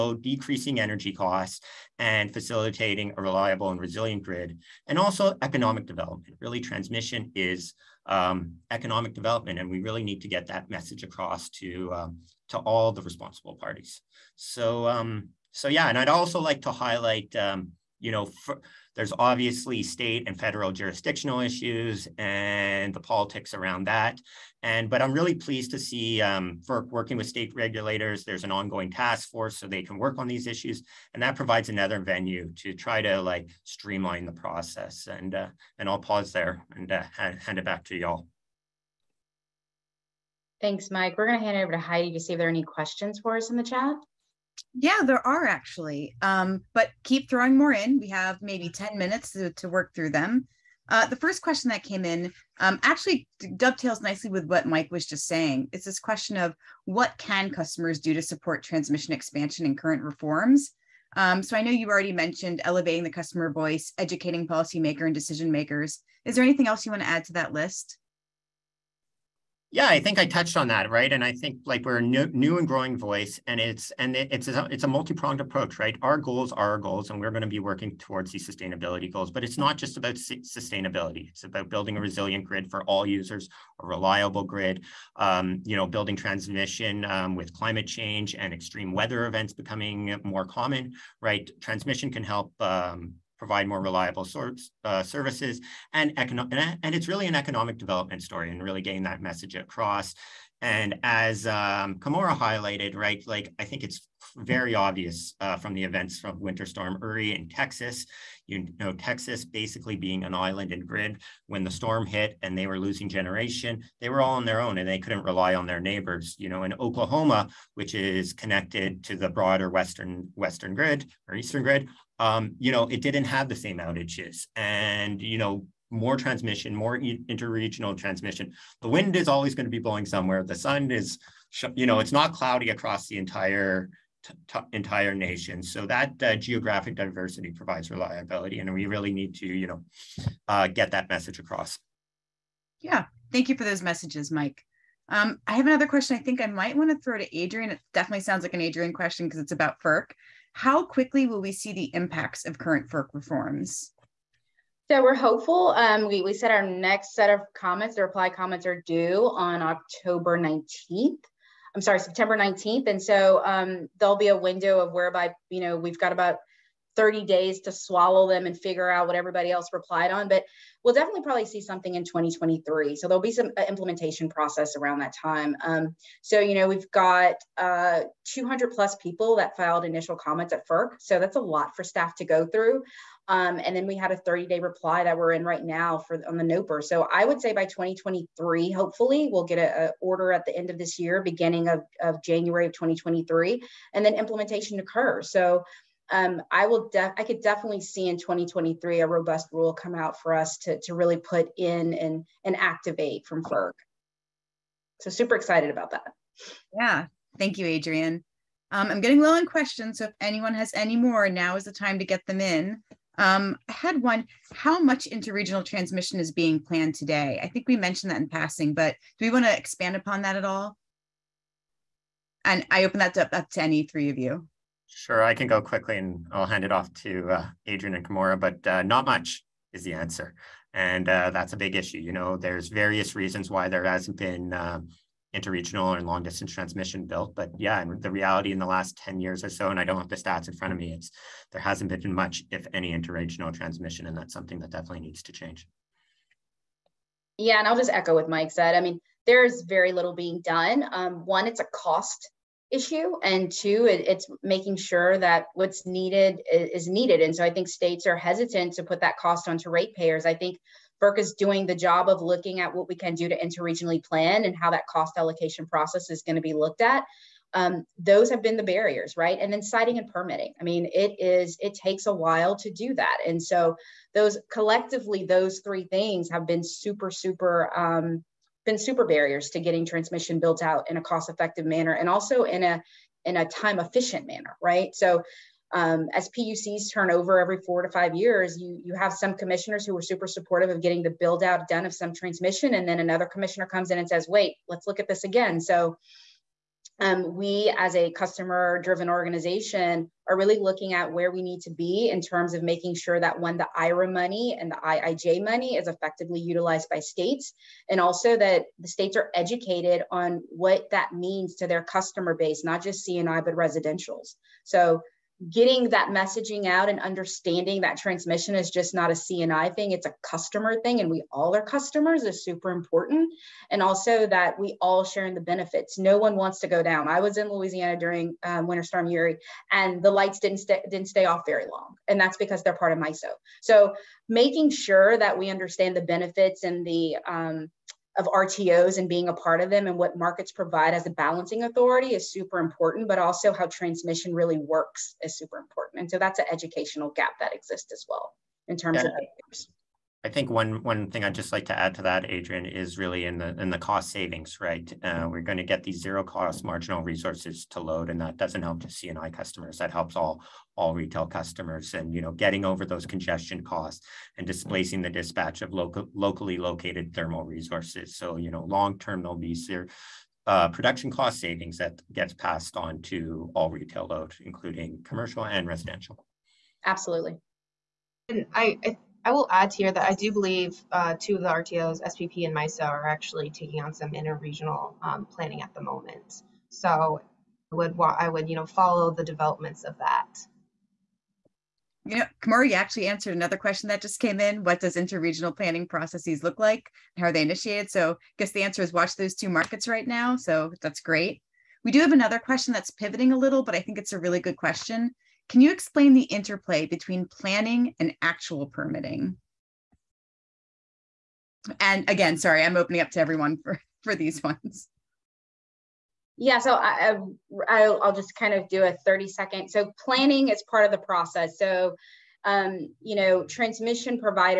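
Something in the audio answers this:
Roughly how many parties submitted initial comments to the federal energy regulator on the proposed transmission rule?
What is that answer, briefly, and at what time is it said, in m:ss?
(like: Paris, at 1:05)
200 plus, at 2:58.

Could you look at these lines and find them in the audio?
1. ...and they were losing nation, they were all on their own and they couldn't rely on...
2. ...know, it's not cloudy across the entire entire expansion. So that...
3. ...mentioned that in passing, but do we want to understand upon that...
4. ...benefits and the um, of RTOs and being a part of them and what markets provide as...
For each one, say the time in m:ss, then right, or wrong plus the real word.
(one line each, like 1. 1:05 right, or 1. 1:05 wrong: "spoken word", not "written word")
1. 1:52 wrong: "generation", not "nation"
2. 2:11 wrong: "nation", not "expansion"
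3. 3:37 wrong: "expand", not "understand"
4. 5:36 right.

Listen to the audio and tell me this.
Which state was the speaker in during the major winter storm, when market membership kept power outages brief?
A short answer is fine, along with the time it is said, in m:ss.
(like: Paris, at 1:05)
Louisiana, at 5:27.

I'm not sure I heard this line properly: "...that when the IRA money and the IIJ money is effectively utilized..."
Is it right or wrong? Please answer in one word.
right.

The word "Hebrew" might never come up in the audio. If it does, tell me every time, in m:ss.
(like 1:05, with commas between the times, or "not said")
not said.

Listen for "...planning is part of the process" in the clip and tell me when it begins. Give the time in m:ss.
7:00.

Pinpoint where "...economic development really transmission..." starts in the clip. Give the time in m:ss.
0:05.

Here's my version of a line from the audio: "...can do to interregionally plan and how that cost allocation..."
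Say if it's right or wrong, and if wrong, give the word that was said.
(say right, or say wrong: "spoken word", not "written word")
right.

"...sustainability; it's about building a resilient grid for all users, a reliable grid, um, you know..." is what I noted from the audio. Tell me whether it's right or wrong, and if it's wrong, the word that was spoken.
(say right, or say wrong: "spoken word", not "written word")
right.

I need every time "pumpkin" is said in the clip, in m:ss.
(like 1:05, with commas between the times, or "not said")
not said.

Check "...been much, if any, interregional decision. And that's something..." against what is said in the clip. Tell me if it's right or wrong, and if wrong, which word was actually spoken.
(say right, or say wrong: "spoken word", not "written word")
wrong: "transmission", not "decision".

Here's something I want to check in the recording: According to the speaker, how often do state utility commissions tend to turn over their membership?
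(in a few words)
every four to five years.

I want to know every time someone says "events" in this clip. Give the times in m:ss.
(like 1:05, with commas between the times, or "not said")
1:29, 1:45.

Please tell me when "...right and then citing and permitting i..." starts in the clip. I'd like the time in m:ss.
4:29.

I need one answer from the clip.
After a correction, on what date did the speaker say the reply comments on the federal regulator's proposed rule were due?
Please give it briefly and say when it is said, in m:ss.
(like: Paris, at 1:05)
September 19th, at 2:41.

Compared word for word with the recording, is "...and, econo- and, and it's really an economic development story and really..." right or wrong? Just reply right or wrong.
right.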